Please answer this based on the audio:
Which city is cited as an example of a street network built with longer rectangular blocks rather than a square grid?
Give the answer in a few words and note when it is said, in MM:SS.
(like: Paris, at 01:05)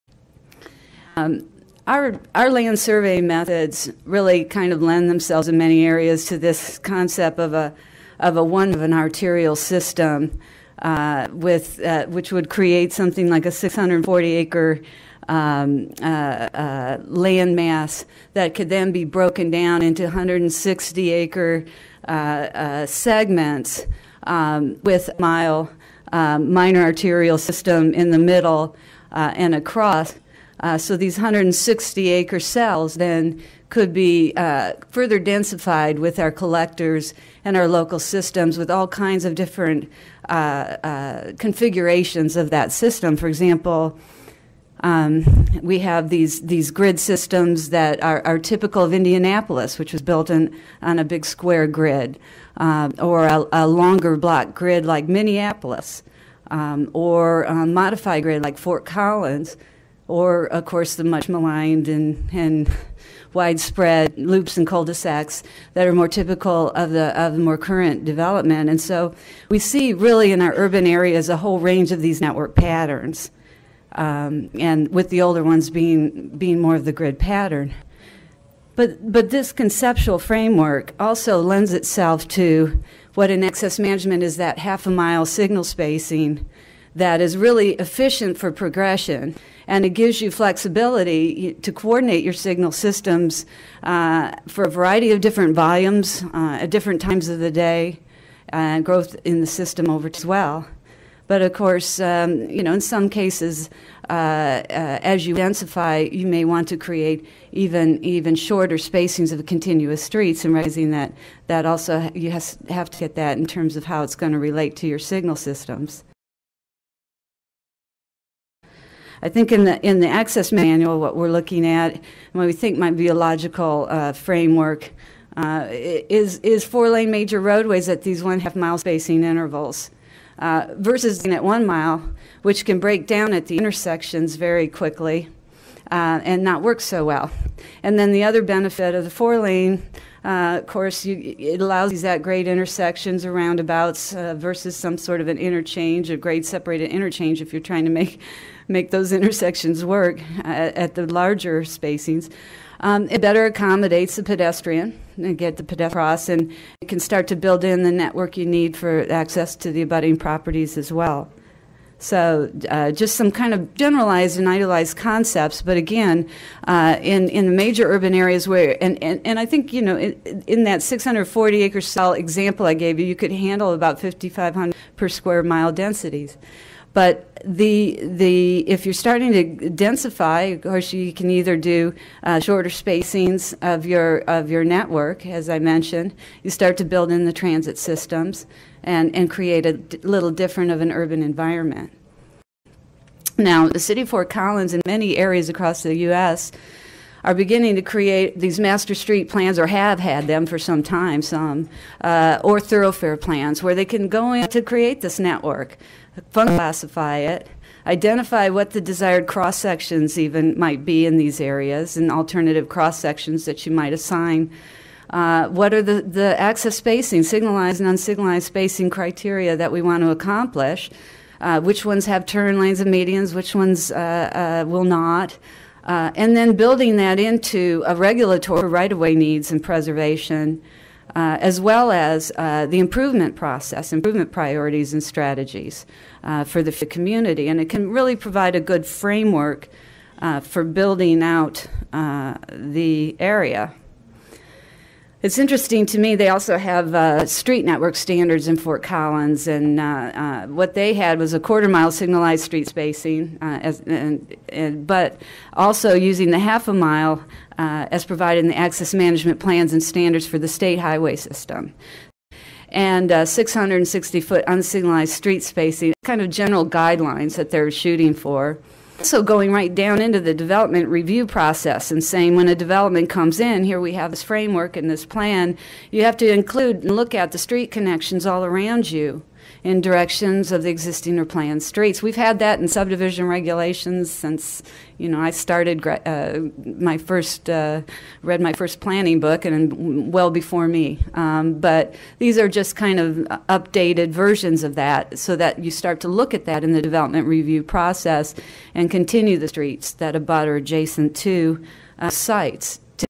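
Minneapolis, at 00:55.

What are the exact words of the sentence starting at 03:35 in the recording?
Uh, what are the, the access spacing, signalized and unsignalized spacing criteria that we want to accomplish?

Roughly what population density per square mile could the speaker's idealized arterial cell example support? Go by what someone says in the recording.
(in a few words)
5,500.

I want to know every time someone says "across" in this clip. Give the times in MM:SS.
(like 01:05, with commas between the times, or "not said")
00:29, 02:35, 03:15.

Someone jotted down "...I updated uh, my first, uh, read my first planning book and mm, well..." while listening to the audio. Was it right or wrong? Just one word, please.
wrong.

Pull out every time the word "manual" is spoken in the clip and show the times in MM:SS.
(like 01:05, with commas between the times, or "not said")
02:00.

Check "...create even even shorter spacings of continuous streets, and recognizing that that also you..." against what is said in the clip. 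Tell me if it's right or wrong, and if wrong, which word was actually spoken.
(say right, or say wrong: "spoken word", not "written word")
right.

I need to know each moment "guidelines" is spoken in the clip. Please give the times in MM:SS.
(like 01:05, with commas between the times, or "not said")
04:26.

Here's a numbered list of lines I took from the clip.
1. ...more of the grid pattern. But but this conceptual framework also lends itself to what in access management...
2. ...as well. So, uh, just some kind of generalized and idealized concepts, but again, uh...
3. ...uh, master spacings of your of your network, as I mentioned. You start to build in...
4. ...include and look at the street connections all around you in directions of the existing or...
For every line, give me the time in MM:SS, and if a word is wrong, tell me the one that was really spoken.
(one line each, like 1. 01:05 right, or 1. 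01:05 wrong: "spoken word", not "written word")
1. 01:16 right
2. 02:40 right
3. 03:02 wrong: "shorter", not "master"
4. 04:36 right.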